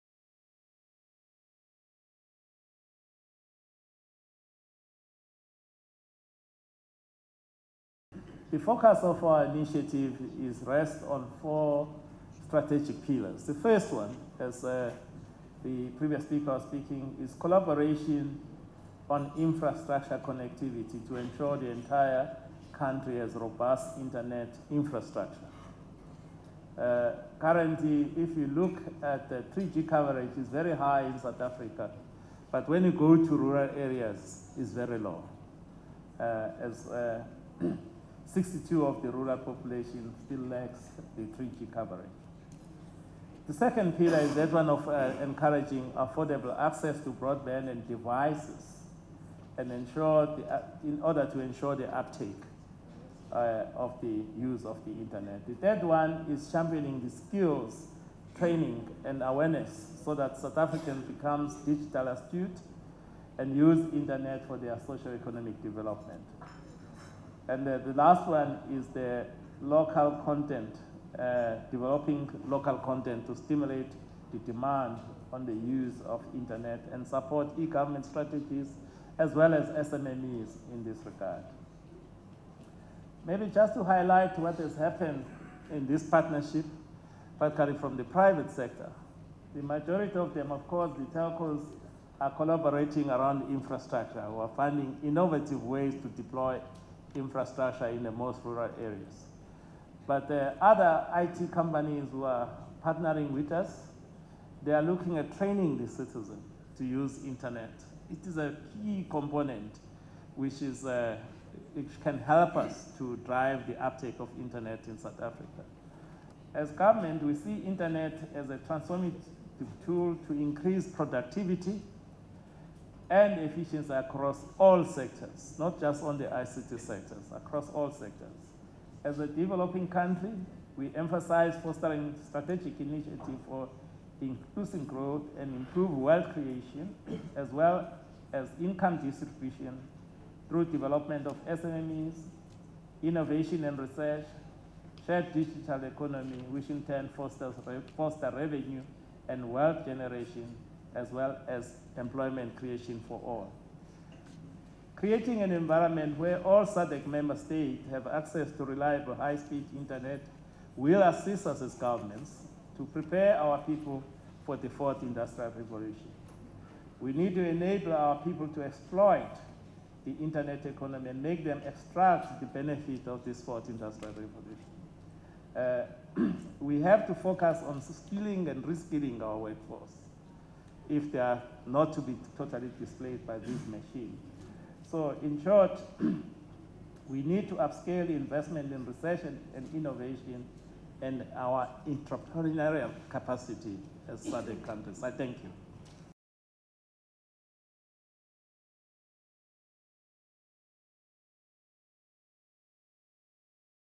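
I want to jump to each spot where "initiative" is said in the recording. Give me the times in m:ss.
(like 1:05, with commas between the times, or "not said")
0:09, 2:12.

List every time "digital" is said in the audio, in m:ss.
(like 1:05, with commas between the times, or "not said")
1:01, 2:25.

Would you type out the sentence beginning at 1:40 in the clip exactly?
But the other IT companies who are partnering with us, they are looking at training the citizen to use internet.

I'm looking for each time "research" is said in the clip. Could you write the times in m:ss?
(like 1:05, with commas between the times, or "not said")
2:23, 3:08.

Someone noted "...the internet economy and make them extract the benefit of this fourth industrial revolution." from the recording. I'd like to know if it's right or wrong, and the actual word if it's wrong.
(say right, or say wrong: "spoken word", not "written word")
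right.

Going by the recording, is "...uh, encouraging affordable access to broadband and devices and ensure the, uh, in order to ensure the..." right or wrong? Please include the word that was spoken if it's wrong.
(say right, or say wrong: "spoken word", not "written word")
right.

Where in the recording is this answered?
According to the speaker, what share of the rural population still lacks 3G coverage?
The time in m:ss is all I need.
0:38.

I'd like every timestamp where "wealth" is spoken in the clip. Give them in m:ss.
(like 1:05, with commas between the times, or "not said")
2:15, 2:29.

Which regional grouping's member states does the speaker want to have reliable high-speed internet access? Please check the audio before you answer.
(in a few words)
SADC.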